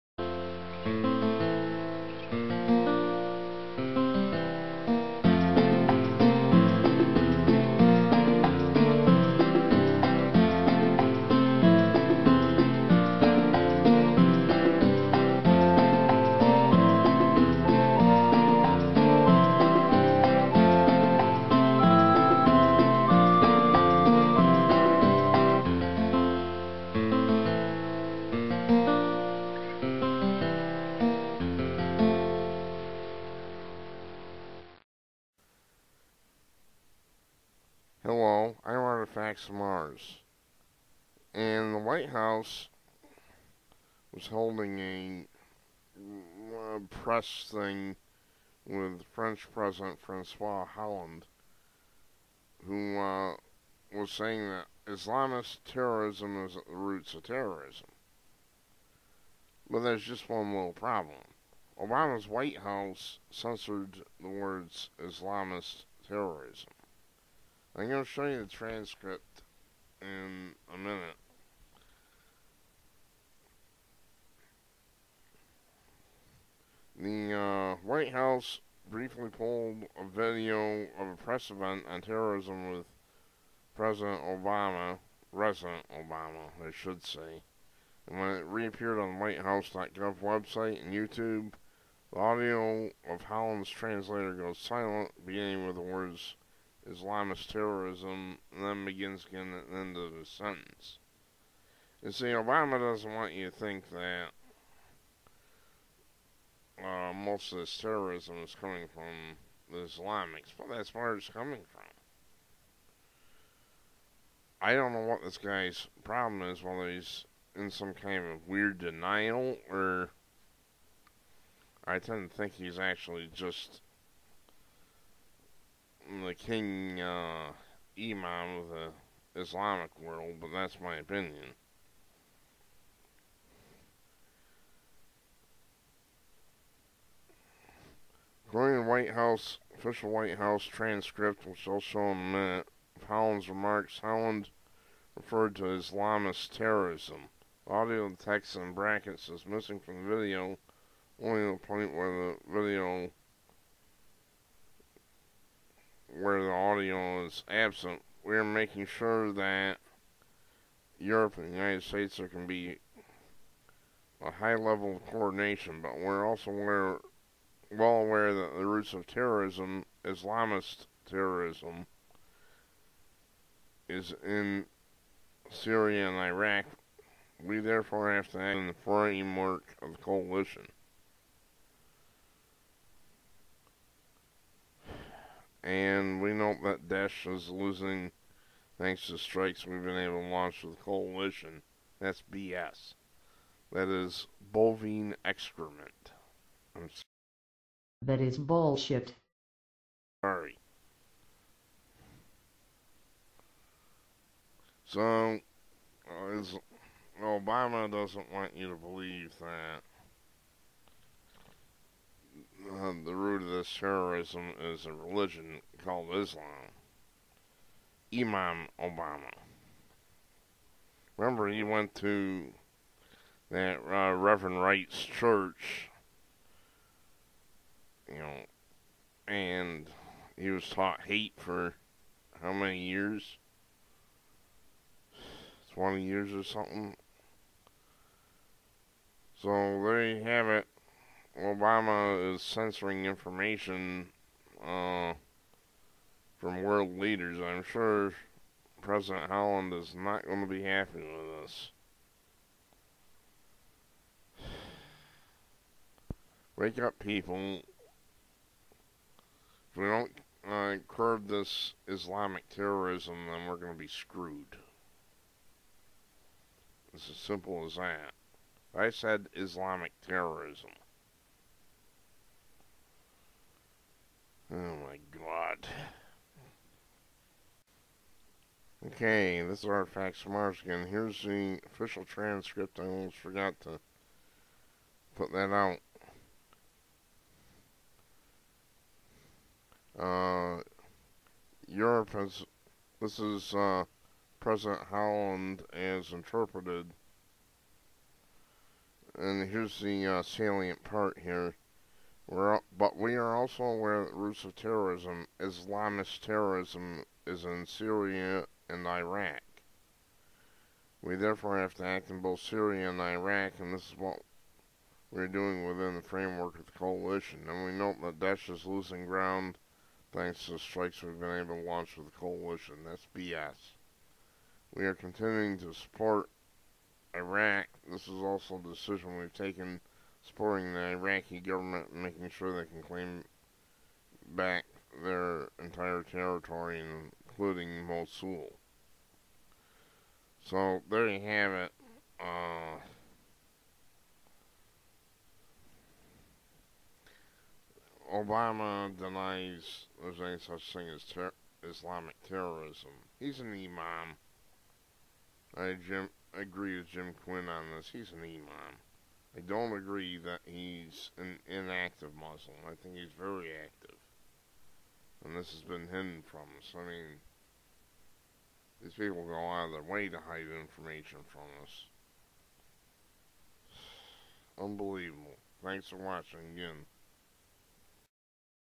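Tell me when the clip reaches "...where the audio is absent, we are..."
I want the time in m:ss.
2:36.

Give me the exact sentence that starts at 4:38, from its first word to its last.
Okay, this is Artifacts Mars again.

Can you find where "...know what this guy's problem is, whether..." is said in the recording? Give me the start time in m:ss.
1:54.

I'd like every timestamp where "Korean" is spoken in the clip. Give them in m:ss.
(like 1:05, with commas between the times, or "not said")
not said.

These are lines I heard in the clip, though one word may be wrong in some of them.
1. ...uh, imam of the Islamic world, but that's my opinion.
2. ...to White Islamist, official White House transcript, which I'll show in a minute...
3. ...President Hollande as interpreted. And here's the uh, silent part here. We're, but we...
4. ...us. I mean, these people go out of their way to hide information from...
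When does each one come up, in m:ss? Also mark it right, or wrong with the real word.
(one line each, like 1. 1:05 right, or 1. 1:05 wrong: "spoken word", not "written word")
1. 2:06 right
2. 2:18 wrong: "House", not "Islamist"
3. 4:54 wrong: "salient", not "silent"
4. 6:06 right.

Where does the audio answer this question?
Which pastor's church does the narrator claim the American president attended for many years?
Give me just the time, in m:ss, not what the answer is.
3:44.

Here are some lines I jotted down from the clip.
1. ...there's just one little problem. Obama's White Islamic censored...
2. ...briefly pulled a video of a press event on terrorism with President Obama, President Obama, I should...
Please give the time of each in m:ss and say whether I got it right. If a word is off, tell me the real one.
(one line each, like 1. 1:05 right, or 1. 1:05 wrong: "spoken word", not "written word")
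1. 0:59 wrong: "House", not "Islamic"
2. 1:18 right.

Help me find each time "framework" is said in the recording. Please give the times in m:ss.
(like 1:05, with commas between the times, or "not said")
2:58, 5:16.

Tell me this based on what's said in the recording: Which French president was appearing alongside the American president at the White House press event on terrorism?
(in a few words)
Francois Hollande.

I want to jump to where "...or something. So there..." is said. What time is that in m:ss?
3:56.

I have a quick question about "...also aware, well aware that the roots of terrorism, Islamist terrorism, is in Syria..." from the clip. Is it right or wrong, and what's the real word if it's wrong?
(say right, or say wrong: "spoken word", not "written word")
right.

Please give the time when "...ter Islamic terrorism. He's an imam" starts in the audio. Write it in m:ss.
5:51.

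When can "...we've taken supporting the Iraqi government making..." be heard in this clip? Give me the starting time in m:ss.
5:29.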